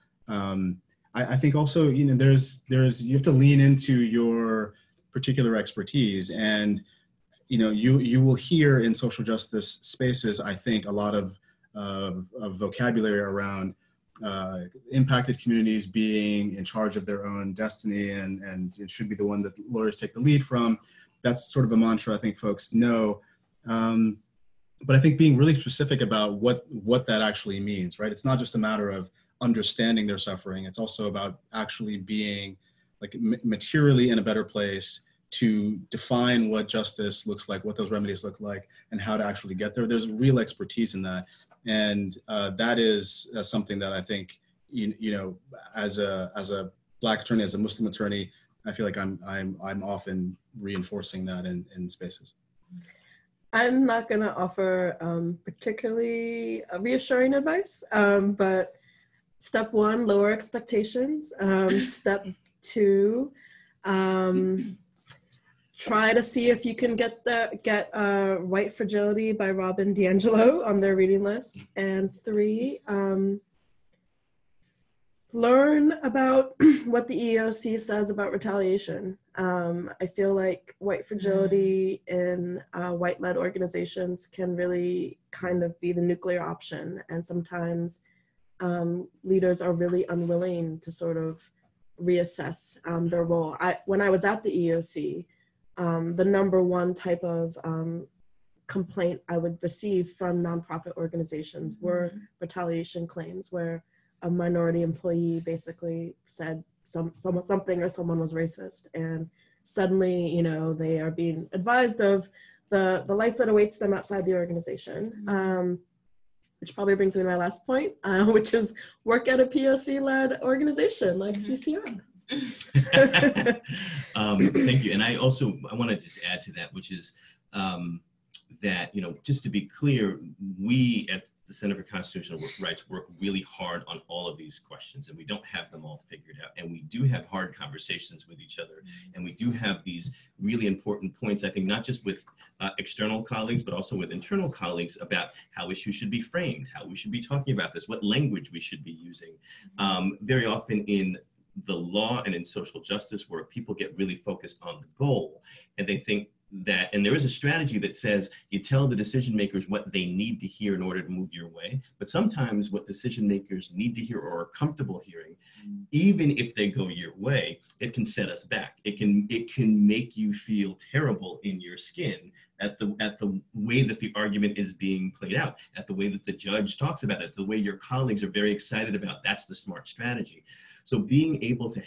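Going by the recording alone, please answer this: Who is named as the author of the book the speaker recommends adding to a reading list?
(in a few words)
Robin DiAngelo.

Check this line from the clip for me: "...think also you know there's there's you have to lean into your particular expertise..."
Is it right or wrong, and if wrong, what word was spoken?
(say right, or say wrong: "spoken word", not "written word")
right.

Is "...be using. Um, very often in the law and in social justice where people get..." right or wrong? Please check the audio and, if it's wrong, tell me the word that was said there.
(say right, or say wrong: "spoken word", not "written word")
right.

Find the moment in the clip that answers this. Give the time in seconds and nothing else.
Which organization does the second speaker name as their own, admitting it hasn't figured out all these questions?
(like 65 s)
131 s.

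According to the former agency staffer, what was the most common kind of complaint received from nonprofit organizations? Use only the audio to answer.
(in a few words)
Retaliation claims.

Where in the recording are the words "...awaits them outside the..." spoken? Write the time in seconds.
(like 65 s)
113 s.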